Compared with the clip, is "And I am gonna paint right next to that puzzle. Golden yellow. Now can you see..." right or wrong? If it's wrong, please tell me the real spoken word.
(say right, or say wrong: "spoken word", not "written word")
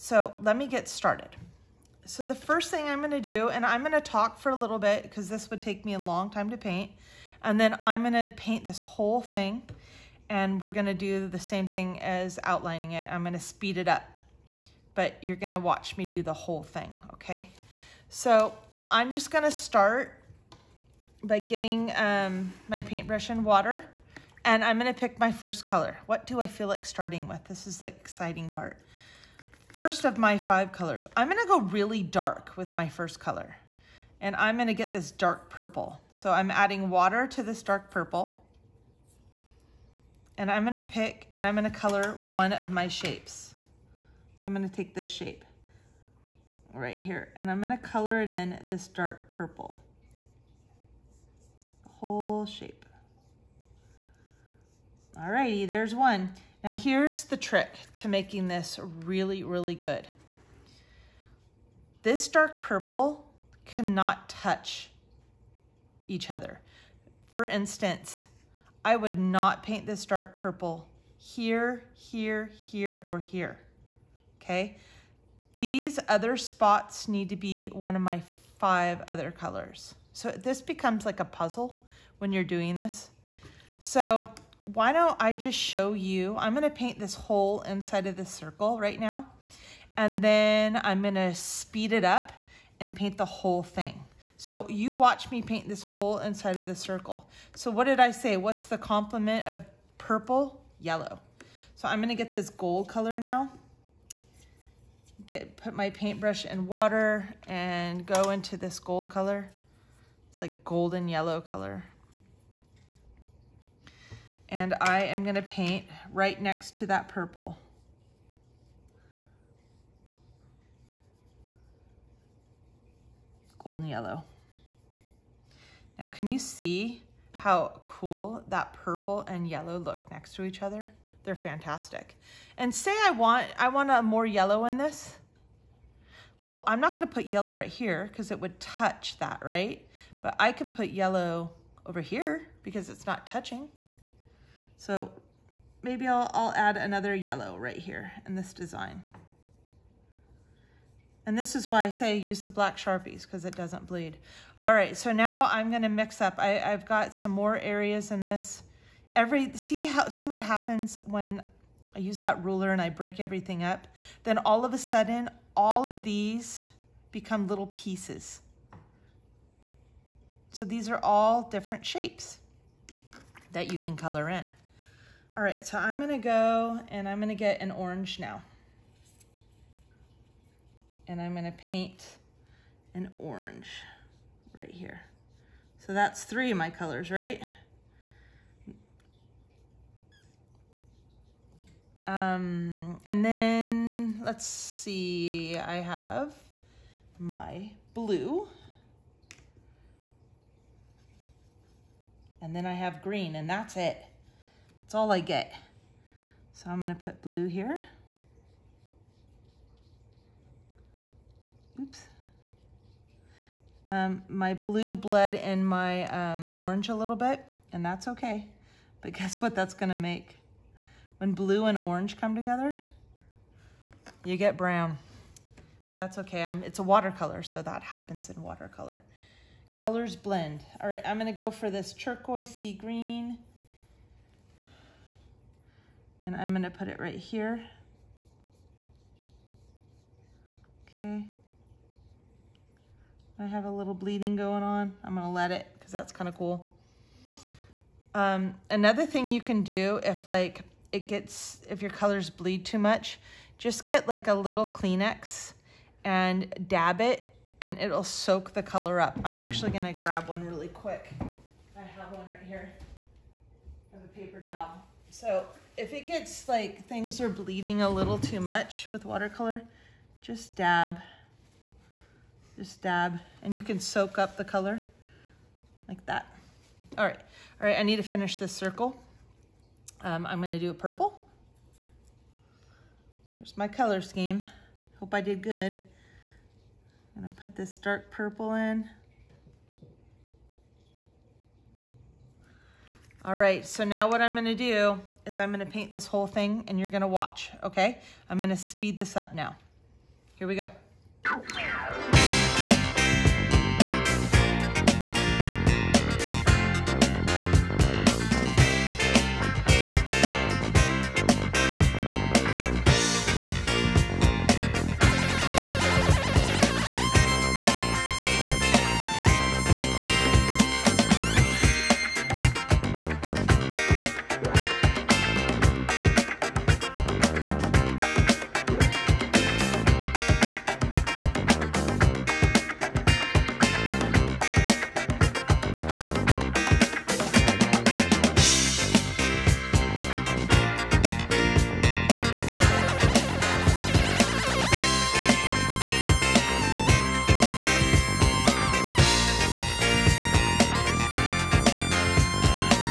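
wrong: "purple", not "puzzle".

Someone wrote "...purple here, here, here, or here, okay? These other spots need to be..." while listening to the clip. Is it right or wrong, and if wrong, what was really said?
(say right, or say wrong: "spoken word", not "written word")
right.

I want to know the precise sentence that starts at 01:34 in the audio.
So you watch me paint this whole inside of the circle.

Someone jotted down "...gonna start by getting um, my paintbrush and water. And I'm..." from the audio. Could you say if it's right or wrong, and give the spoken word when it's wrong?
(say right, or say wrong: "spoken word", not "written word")
right.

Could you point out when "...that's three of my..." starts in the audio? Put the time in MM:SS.
03:05.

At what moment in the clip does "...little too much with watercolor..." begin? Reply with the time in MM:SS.
04:27.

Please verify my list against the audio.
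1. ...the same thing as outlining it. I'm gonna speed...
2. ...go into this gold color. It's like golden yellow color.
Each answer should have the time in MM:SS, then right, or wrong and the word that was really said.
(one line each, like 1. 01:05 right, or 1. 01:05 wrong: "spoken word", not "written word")
1. 00:11 right
2. 01:48 right.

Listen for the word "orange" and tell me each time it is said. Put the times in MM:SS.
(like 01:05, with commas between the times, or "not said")
02:57, 03:03, 03:36, 03:41.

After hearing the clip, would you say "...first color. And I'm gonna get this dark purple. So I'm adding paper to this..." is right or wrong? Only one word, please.
wrong.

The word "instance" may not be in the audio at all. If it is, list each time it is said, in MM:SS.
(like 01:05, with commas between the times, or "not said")
01:07.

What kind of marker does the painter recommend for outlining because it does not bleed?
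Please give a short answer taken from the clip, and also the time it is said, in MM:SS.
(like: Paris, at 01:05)
Black Sharpies, at 02:32.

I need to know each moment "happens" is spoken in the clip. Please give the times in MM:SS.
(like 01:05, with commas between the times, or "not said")
02:40, 03:47.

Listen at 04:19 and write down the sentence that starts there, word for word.
I'm actually gonna grab one really quick.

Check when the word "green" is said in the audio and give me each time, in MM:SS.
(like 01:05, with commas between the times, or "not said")
03:23, 03:52.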